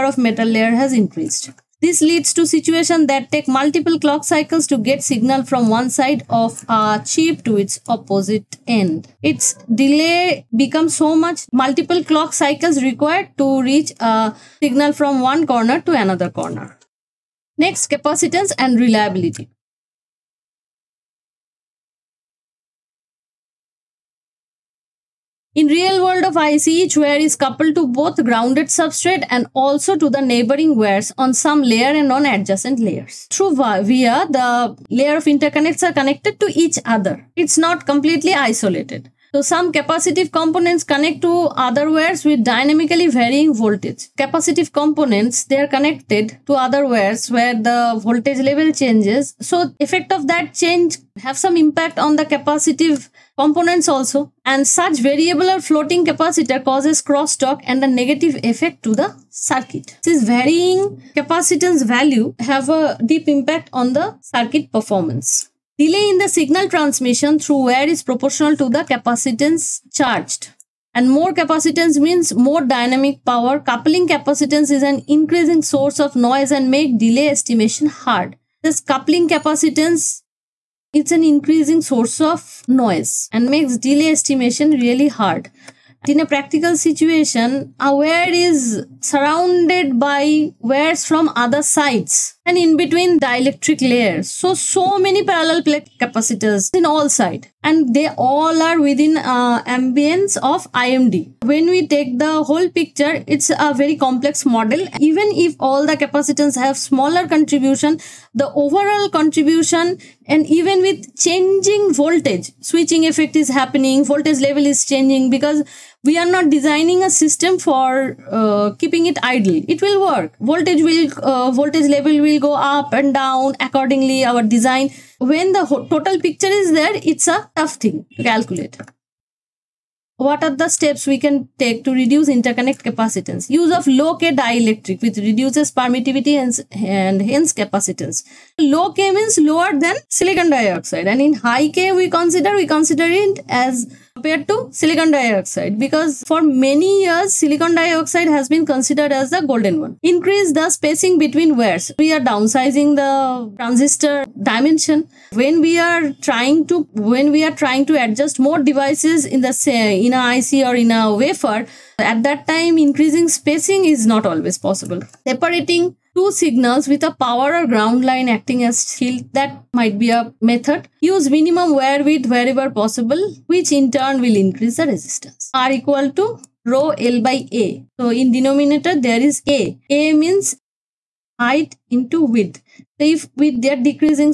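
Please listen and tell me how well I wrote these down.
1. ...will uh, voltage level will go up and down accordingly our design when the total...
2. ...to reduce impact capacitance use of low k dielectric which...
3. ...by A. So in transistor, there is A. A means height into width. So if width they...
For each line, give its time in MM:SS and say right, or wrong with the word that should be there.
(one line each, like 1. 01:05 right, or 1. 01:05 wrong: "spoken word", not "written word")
1. 02:00 right
2. 02:11 wrong: "interconnect", not "impact"
3. 02:57 wrong: "denominator", not "transistor".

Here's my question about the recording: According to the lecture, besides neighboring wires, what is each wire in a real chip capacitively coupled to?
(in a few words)
grounded substrate.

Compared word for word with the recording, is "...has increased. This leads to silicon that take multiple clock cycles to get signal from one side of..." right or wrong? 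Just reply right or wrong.
wrong.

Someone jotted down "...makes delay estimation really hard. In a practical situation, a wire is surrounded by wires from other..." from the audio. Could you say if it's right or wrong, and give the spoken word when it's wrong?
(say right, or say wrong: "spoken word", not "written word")
right.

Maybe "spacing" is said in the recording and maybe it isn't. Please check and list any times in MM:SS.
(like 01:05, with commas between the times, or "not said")
02:30, 02:43.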